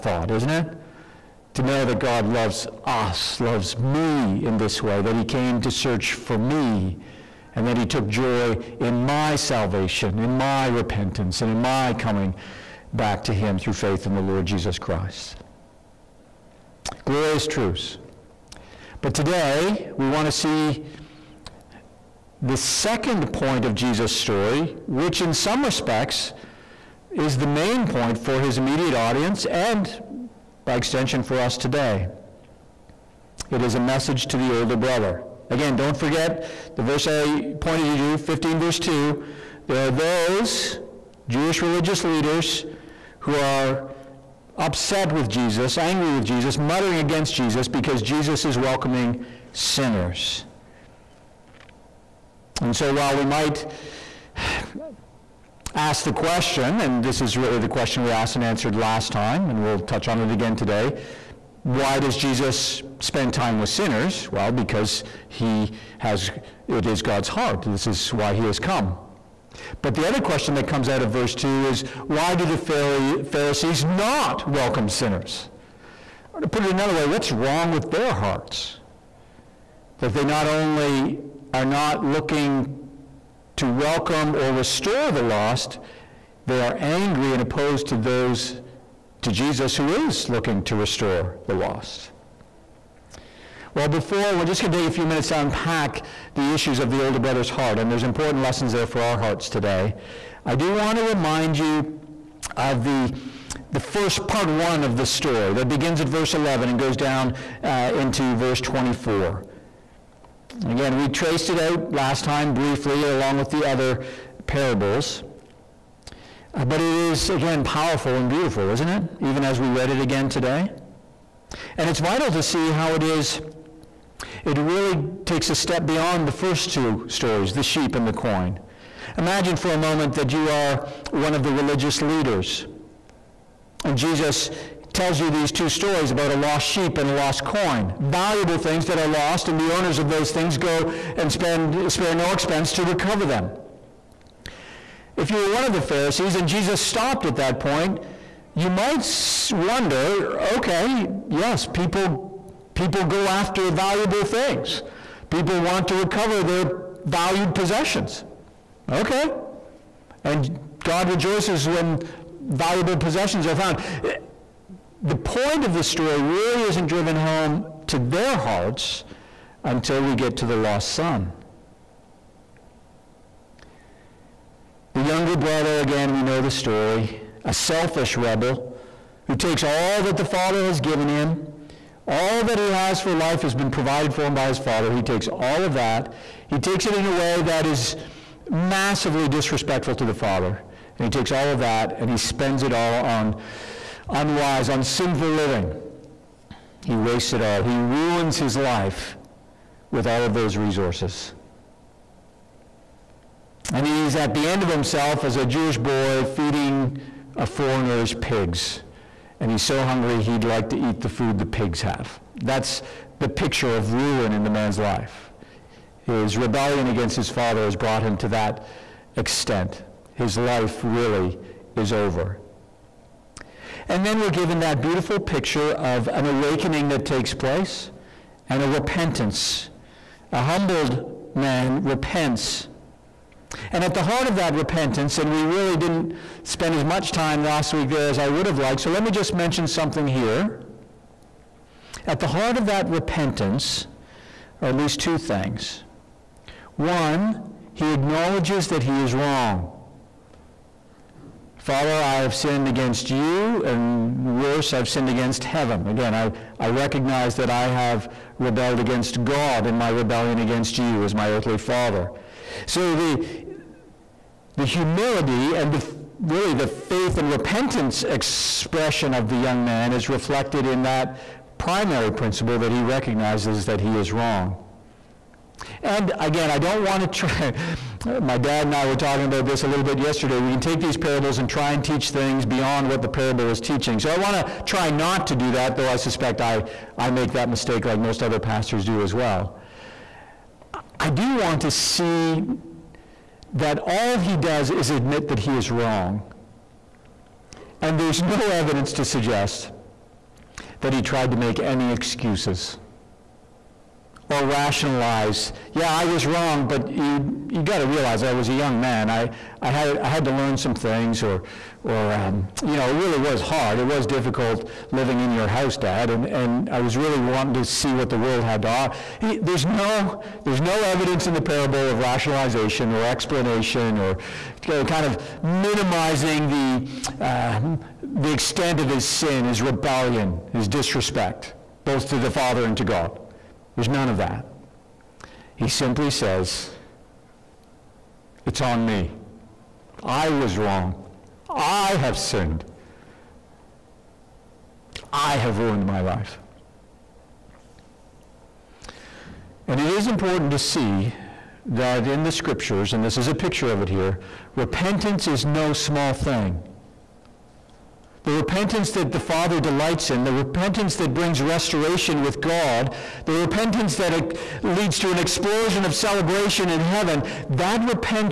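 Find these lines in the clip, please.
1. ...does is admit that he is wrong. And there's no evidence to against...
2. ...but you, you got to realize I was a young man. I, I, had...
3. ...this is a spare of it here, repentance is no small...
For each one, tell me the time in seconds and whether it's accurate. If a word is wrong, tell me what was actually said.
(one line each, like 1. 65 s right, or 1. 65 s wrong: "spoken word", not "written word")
1. 294 s wrong: "suggest", not "against"
2. 306 s right
3. 353 s wrong: "picture", not "spare".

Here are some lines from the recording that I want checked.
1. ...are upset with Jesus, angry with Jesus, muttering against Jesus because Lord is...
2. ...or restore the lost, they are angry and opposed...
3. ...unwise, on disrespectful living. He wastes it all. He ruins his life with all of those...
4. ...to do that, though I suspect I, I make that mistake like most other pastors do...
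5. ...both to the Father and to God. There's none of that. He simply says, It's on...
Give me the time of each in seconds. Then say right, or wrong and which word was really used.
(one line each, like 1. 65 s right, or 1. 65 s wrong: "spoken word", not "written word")
1. 43 s wrong: "Jesus", not "Lord"
2. 84 s right
3. 194 s wrong: "sinful", not "disrespectful"
4. 285 s right
5. 331 s right.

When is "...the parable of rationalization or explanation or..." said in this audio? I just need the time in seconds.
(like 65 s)
321 s.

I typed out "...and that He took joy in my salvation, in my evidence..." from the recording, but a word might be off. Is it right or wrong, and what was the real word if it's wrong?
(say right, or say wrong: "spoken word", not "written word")
wrong: "repentance", not "evidence".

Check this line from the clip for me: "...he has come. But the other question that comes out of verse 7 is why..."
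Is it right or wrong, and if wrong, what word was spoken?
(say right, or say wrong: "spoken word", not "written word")
wrong: "2", not "7".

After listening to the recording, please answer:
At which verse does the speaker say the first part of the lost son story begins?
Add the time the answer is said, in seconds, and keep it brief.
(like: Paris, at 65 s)
verse 11, at 106 s.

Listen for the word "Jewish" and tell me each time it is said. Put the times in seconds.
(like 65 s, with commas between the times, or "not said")
41 s, 205 s.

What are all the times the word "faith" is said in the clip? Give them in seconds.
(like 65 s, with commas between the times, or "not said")
13 s, 266 s.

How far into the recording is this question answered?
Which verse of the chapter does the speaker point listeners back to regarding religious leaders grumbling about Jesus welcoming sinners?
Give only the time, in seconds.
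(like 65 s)
38 s.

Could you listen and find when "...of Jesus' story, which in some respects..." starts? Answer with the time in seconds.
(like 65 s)
23 s.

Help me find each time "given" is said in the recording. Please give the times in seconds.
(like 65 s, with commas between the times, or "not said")
180 s, 224 s.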